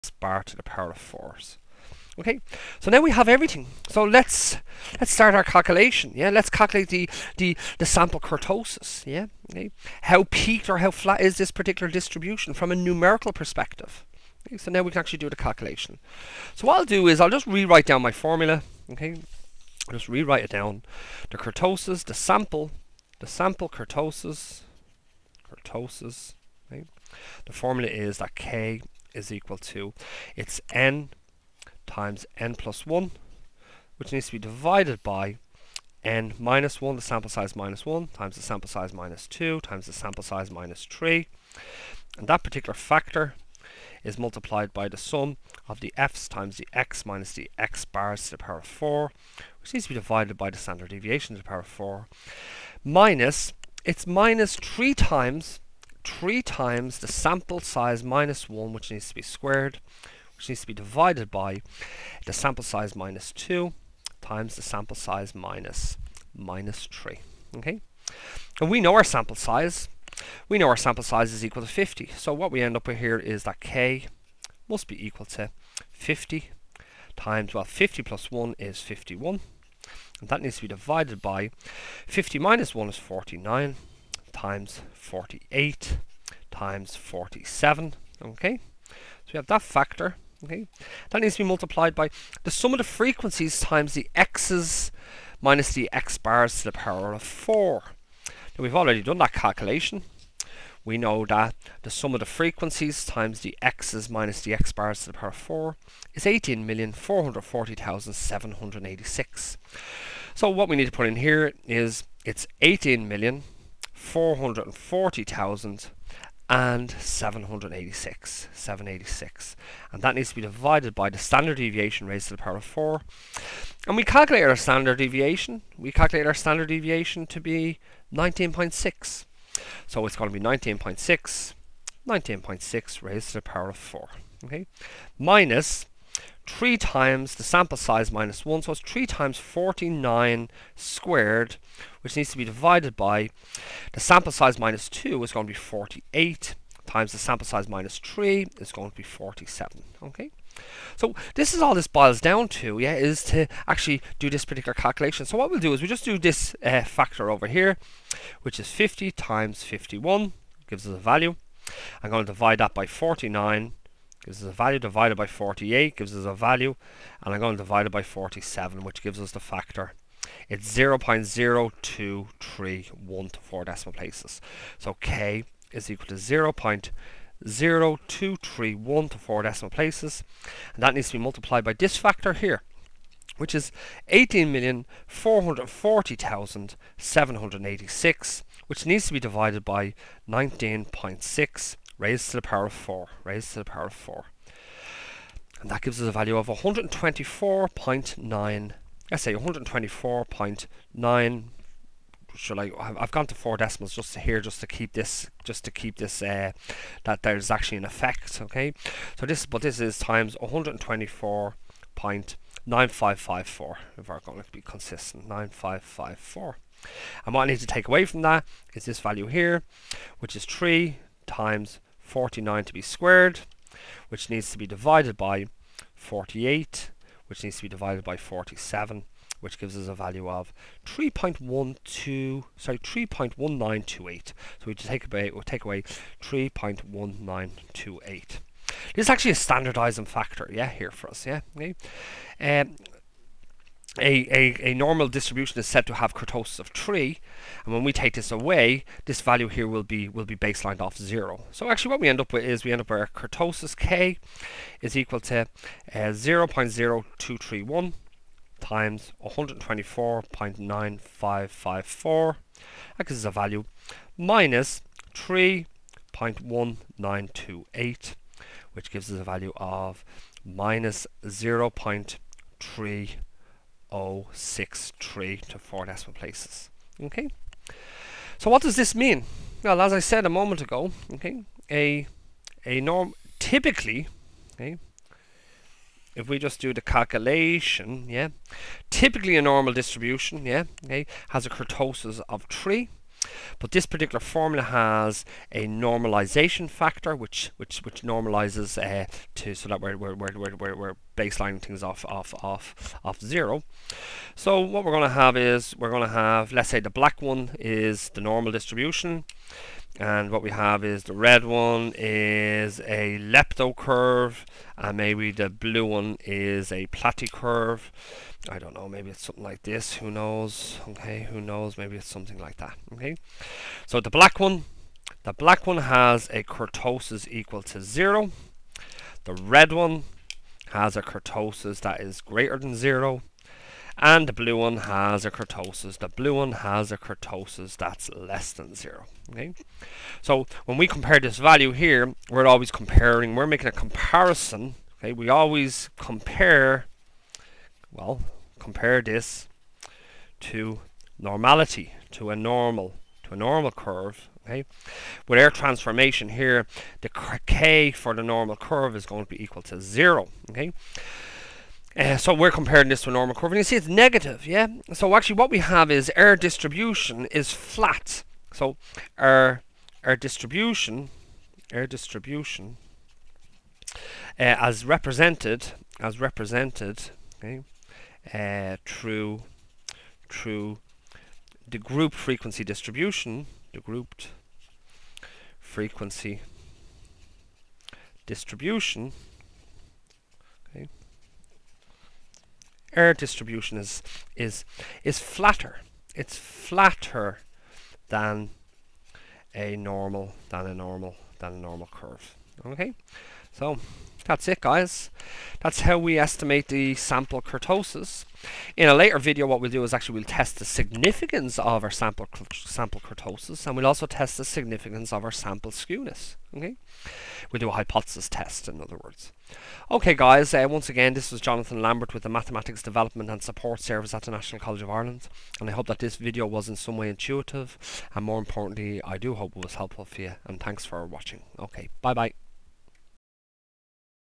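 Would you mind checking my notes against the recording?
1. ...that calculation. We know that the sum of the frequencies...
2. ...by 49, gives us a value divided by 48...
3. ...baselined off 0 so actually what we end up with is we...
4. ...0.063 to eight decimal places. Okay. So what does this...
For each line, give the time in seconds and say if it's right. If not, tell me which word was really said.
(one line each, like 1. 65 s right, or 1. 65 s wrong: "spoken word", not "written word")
1. 99 s right
2. 162 s right
3. 250 s right
4. 273 s wrong: "four", not "eight".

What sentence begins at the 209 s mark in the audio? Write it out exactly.
So this, but this is times 124.9554, if we're going to be consistent, 9554.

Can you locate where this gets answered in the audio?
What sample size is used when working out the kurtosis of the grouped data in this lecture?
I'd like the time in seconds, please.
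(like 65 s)
70 s.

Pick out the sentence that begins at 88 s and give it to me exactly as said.
Okay, so we have that factor.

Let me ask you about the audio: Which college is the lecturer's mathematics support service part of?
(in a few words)
National College of Ireland.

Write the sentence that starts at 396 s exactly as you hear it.
It's flatter than a normal than a normal than a normal curve.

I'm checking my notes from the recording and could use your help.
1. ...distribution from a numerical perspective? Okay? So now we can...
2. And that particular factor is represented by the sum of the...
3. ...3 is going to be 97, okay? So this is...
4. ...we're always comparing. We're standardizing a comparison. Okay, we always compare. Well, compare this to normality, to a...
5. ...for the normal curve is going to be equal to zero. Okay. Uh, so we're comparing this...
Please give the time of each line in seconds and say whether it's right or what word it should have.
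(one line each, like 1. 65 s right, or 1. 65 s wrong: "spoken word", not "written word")
1. 11 s right
2. 42 s wrong: "multiplied", not "represented"
3. 147 s wrong: "47", not "97"
4. 342 s wrong: "making", not "standardizing"
5. 357 s right.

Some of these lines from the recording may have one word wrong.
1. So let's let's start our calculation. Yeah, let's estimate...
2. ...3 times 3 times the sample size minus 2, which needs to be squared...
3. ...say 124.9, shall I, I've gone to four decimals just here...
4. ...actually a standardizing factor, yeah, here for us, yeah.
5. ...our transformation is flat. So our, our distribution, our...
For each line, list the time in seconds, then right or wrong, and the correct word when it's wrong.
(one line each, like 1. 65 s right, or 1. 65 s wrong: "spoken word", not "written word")
1. 3 s wrong: "calculate", not "estimate"
2. 54 s wrong: "1", not "2"
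3. 199 s right
4. 239 s right
5. 366 s wrong: "distribution", not "transformation".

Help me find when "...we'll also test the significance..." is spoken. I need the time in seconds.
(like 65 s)
413 s.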